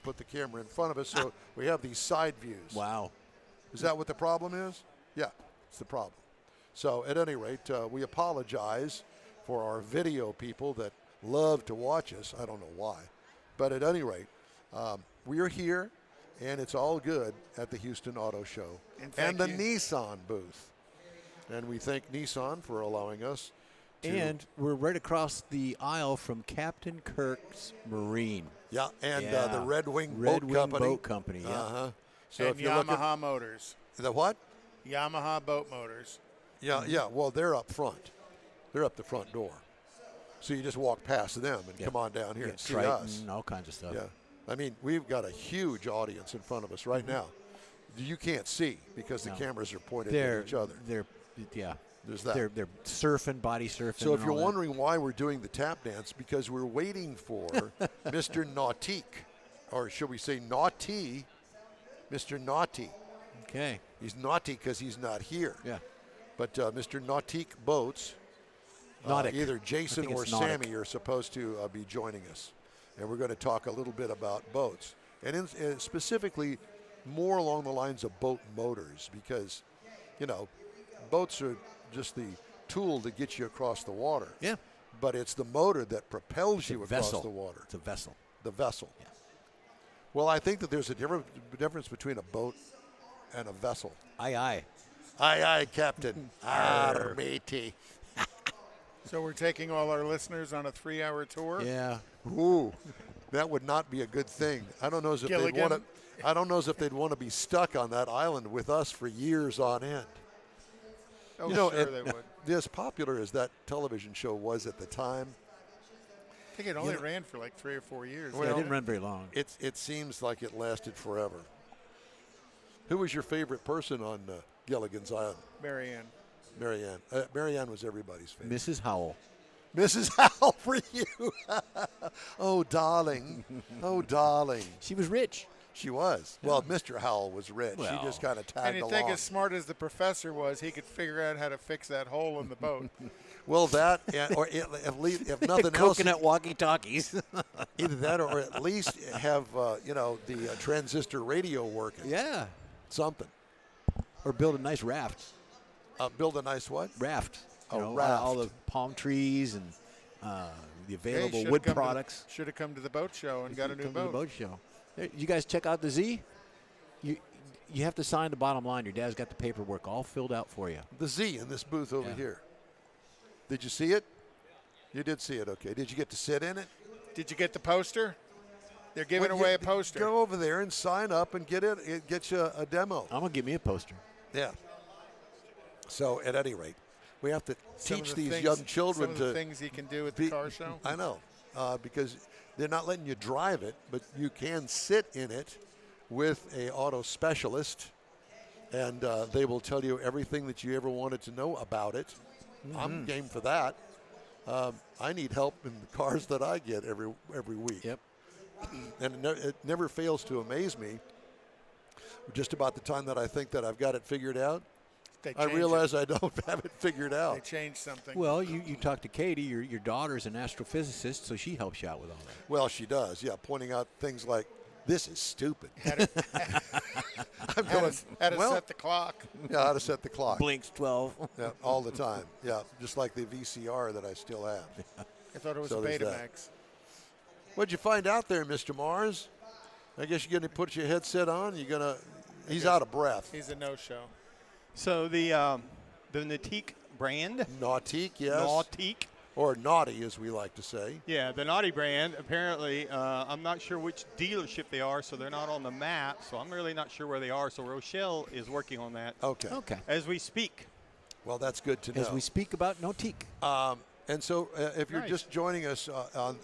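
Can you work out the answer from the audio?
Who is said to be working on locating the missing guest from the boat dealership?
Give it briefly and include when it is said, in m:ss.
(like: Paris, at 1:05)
Rochelle, at 4:17.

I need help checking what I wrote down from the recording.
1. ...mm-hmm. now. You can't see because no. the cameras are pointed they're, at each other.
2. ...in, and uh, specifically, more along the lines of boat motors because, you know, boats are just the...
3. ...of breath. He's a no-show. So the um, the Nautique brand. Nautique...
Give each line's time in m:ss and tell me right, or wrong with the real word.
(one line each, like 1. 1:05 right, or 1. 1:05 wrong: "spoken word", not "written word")
1. 0:47 right
2. 1:15 right
3. 4:02 right.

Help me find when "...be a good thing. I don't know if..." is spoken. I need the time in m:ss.
1:43.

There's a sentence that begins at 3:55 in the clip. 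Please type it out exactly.
I thought it was so Betamax.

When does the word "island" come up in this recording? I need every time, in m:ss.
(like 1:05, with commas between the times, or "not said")
1:48, 2:05.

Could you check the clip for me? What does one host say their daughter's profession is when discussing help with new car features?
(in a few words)
Astrophysicist.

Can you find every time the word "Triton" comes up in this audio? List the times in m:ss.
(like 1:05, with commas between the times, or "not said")
0:42.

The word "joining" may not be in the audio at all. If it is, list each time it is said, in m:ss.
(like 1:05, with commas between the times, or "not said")
1:11, 4:25.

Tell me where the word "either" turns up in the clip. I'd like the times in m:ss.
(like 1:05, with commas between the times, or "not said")
1:09, 2:27.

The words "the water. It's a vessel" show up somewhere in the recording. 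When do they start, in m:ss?
1:27.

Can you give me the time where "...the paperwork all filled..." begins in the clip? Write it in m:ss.
2:49.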